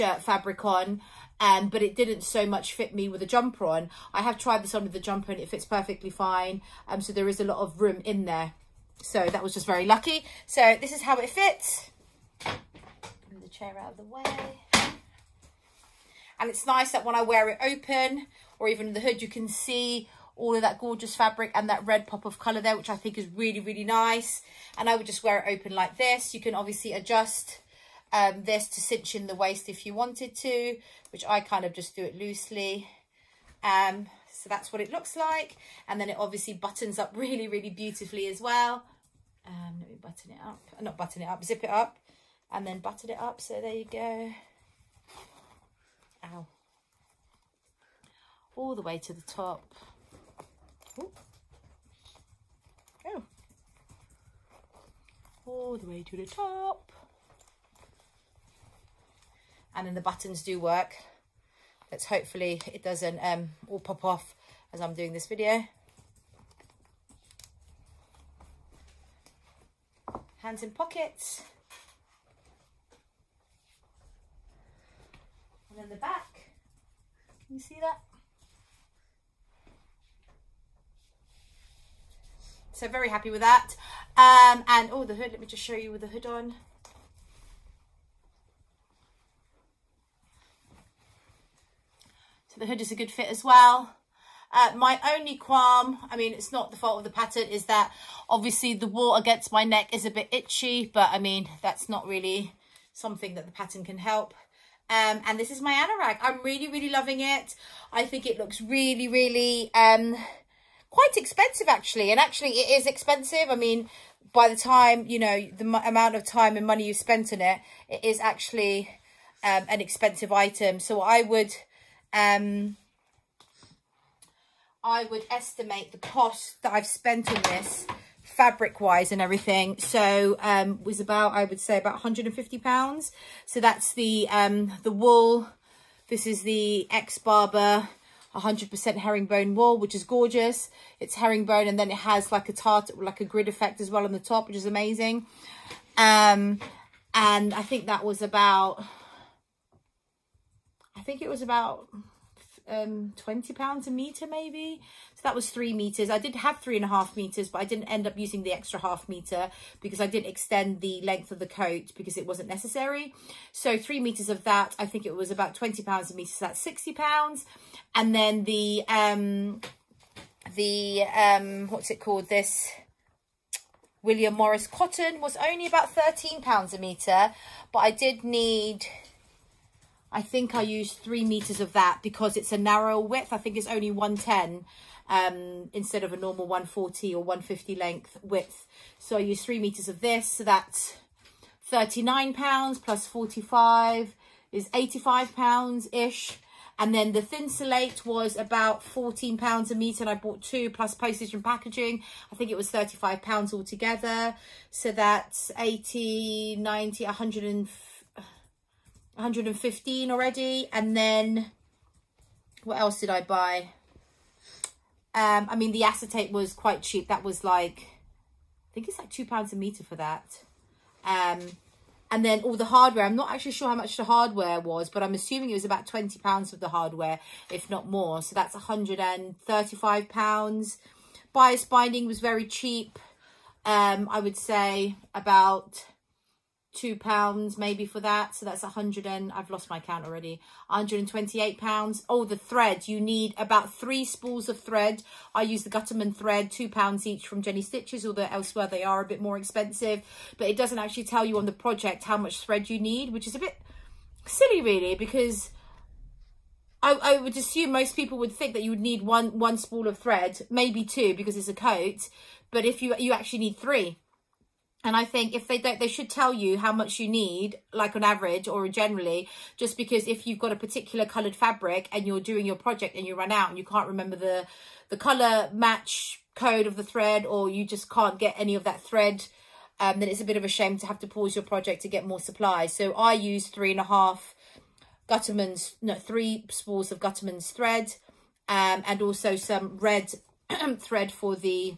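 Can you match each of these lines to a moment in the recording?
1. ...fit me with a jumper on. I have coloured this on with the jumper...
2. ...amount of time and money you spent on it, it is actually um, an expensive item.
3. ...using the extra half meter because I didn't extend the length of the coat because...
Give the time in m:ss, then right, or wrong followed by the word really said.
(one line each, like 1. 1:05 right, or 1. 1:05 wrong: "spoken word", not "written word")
1. 0:02 wrong: "tried", not "coloured"
2. 1:55 right
3. 2:38 right.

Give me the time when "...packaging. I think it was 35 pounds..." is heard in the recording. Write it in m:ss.
3:21.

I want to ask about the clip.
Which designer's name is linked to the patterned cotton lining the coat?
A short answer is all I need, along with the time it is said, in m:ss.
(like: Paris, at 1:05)
William Morris, at 2:54.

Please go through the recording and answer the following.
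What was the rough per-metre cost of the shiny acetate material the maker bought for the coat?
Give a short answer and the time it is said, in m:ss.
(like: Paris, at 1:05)
£2, at 3:39.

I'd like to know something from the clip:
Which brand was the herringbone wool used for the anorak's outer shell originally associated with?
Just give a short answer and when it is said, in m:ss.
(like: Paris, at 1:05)
Barbour, at 2:17.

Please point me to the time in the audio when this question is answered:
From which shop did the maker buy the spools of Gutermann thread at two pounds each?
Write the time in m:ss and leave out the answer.
4:07.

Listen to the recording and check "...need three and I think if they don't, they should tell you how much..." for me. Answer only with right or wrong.
right.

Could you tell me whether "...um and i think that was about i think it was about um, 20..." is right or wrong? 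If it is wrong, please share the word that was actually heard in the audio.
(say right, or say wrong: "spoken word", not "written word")
right.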